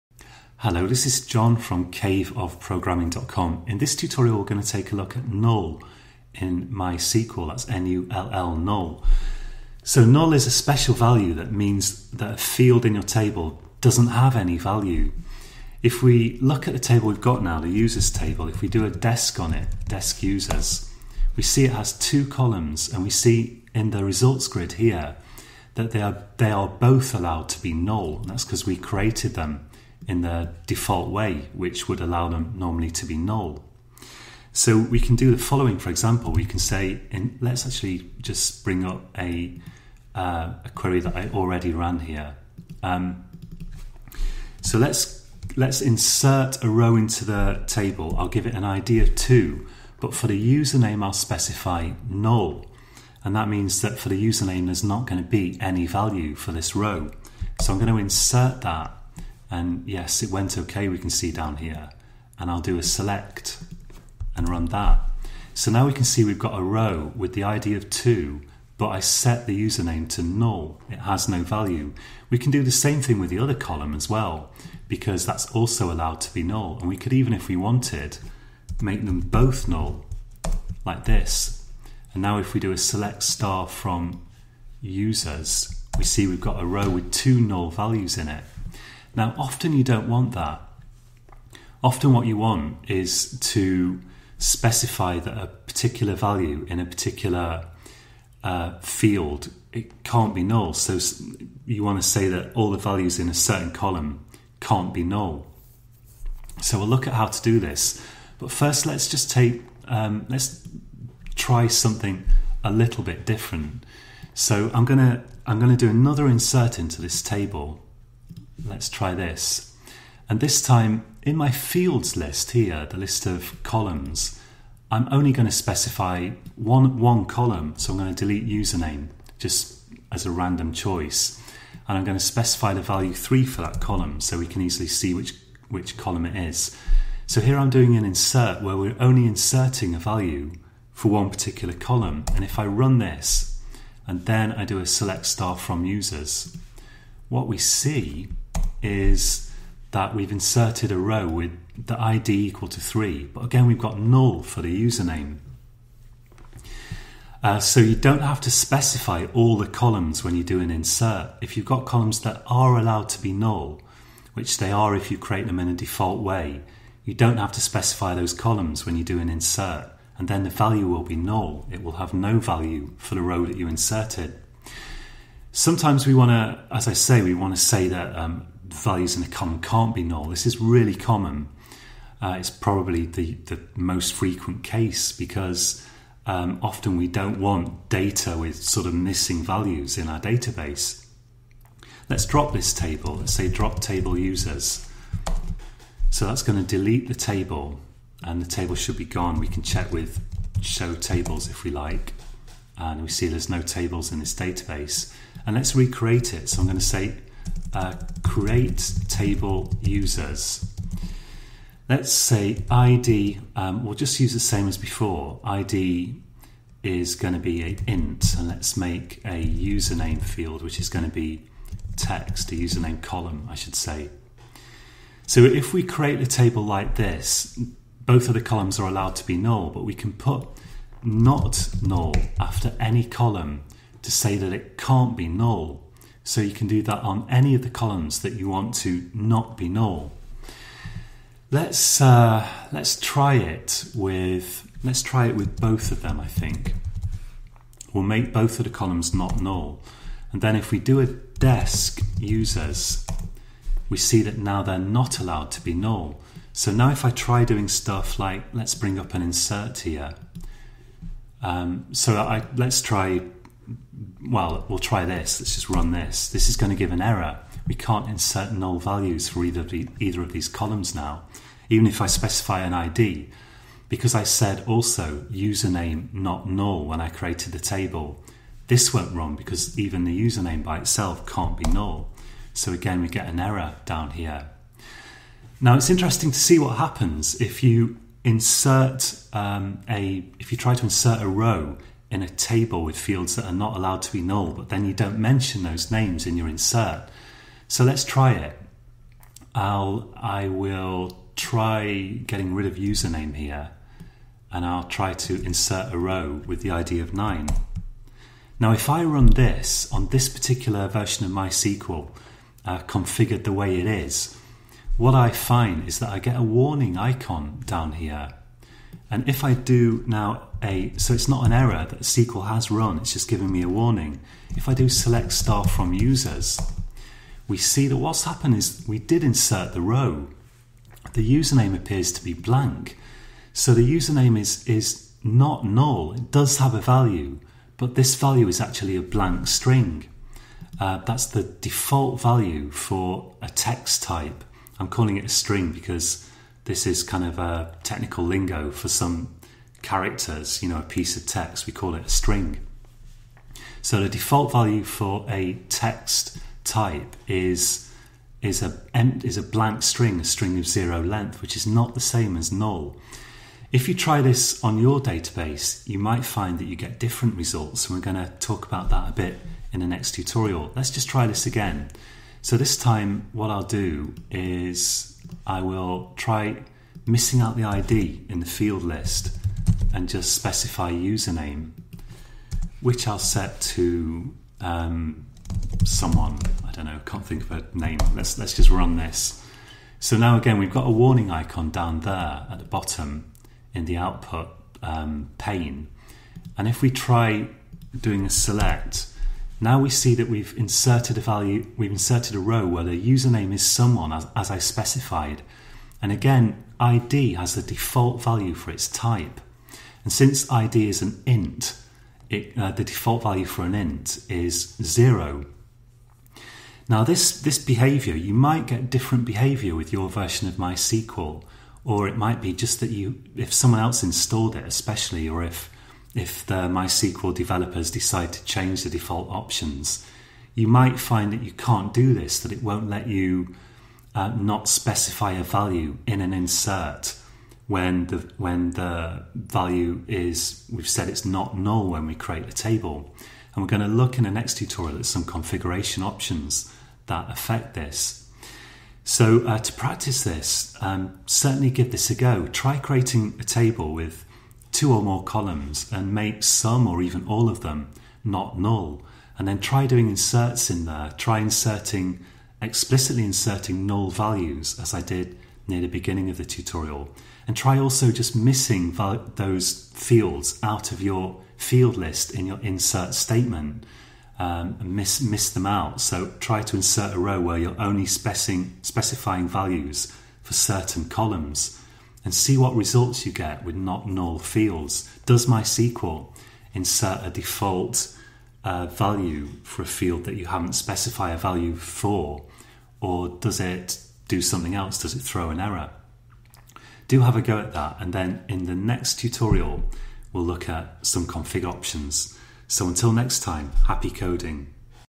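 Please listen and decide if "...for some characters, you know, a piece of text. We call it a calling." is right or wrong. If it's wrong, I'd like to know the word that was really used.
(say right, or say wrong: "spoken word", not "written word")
wrong: "string", not "calling".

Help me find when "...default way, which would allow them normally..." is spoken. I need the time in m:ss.
0:30.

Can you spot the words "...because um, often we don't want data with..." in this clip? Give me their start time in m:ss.
3:05.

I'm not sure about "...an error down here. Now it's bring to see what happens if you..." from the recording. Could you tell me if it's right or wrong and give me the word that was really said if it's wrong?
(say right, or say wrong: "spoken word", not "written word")
wrong: "interesting", not "bring".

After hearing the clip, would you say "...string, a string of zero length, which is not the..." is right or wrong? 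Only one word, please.
right.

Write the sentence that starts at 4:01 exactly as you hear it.
Let's uh, let's try it with let's try it with both of them.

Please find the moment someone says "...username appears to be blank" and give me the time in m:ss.
5:31.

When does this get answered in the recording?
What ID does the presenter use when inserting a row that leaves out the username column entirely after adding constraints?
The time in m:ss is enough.
5:07.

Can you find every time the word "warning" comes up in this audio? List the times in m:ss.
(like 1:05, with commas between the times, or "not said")
5:16, 5:23, 6:30.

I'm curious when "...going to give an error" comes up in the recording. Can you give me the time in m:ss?
4:26.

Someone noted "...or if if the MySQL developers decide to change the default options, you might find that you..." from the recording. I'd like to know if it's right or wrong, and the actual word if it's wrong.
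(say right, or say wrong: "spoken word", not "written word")
right.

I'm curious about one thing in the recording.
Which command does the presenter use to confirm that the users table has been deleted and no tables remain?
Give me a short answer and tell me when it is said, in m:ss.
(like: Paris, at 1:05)
show tables, at 3:20.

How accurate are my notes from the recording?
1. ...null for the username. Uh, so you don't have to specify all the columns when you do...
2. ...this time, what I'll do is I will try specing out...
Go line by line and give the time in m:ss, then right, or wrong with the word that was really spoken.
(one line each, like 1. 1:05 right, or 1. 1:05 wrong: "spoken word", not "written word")
1. 2:33 right
2. 6:12 wrong: "missing", not "specing".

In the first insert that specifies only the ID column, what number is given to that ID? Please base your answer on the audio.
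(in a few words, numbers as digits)
3.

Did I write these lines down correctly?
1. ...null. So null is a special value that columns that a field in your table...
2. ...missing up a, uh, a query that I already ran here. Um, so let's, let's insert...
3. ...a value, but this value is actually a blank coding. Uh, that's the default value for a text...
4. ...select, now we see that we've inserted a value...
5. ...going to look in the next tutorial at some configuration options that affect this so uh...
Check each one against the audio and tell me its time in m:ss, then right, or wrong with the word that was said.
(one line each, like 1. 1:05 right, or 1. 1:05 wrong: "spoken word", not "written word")
1. 0:08 wrong: "means", not "columns"
2. 0:38 wrong: "bring", not "missing"
3. 5:36 wrong: "string", not "coding"
4. 6:38 right
5. 7:23 right.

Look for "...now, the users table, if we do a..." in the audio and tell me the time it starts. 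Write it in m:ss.
0:17.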